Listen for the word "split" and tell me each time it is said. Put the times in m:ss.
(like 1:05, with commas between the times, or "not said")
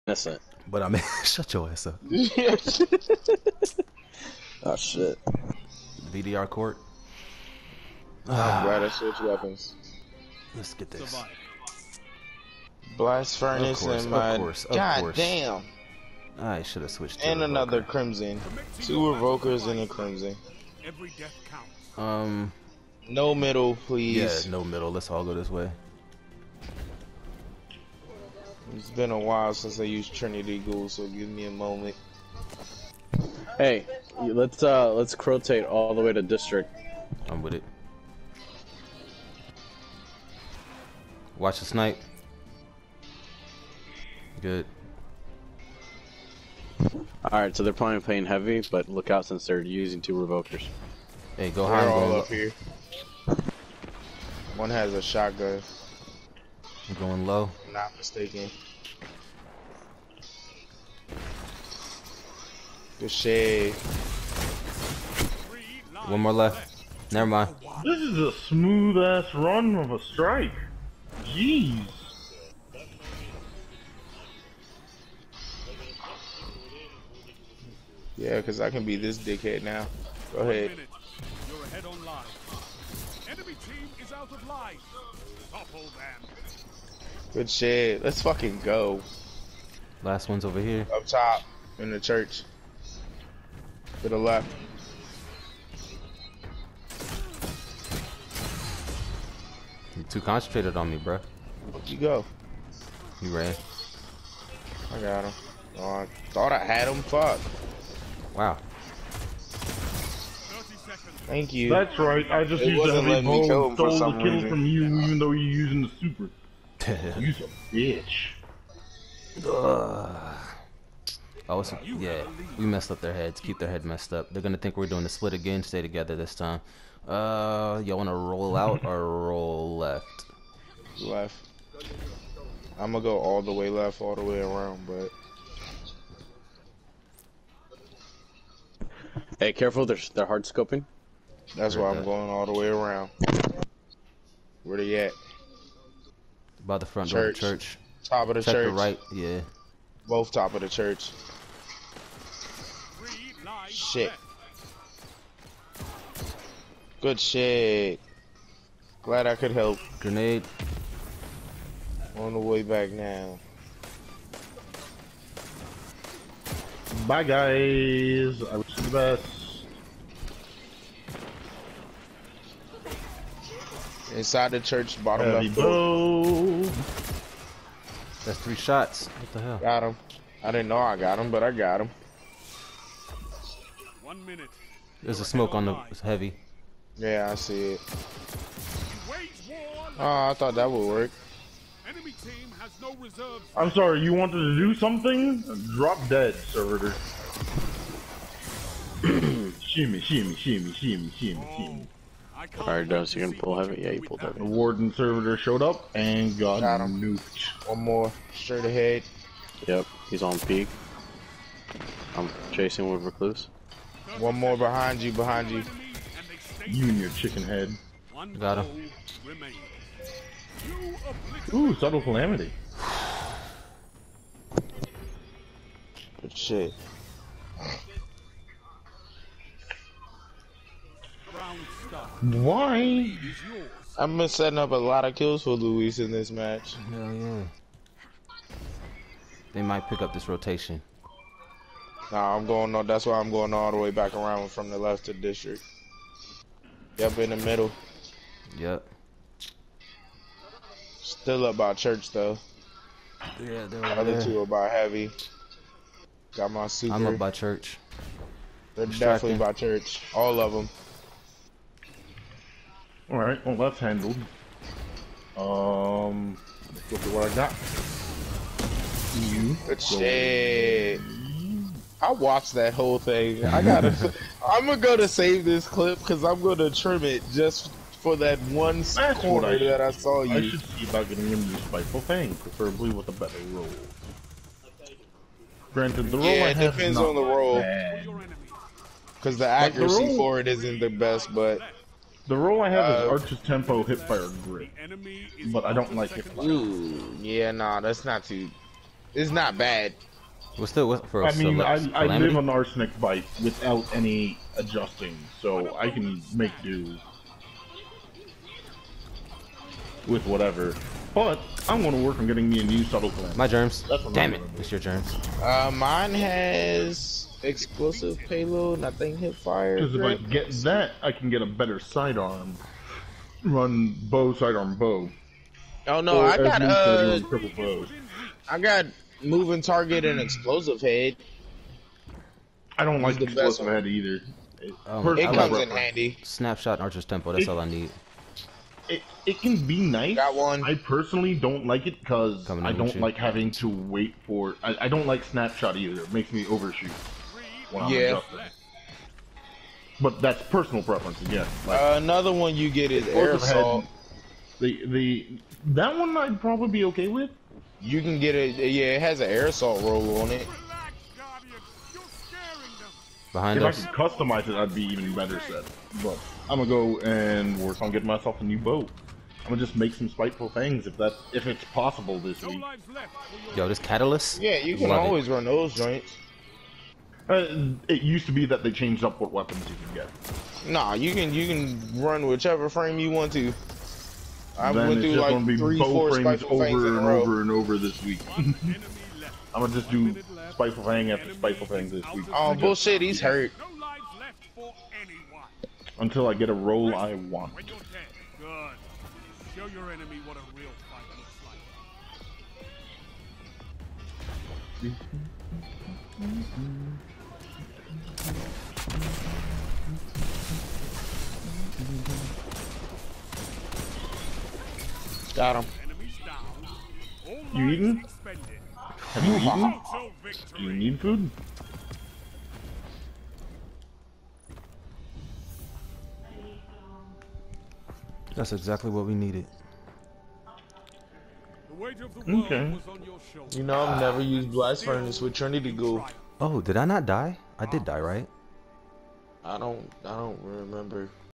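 2:05.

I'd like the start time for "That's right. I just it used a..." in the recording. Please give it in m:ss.
1:51.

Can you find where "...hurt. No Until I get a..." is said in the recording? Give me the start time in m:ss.
6:33.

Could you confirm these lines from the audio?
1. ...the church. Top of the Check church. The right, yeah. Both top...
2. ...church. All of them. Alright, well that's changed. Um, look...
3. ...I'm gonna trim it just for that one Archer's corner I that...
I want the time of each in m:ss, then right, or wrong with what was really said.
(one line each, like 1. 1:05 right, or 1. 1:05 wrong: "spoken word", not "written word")
1. 2:27 right
2. 4:19 wrong: "handled", not "changed"
3. 4:36 wrong: "That", not "Archer".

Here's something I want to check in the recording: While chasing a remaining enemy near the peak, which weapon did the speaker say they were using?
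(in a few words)
Recluse.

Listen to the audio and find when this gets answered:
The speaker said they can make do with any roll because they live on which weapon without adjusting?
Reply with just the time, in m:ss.
5:02.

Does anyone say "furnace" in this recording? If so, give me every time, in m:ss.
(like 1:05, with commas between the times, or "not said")
0:13, 7:14.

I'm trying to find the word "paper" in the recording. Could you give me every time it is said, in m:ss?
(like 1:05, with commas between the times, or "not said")
not said.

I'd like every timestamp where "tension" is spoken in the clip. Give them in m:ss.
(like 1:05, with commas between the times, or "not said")
not said.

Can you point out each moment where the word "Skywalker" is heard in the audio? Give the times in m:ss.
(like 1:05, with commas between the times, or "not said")
not said.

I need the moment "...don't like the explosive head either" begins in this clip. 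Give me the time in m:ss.
5:32.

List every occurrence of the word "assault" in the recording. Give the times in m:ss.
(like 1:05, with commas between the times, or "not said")
5:53, 5:59.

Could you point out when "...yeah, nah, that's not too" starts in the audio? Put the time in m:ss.
4:57.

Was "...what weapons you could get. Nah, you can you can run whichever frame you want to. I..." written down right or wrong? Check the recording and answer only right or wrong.
right.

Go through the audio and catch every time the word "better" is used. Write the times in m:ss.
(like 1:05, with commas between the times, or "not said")
4:43, 5:21, 6:05.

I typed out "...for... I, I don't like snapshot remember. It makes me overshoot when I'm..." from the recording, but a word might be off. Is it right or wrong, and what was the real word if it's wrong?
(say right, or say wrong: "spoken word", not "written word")
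wrong: "either", not "remember".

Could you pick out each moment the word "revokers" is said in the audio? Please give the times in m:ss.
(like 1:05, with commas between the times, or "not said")
0:19, 0:50.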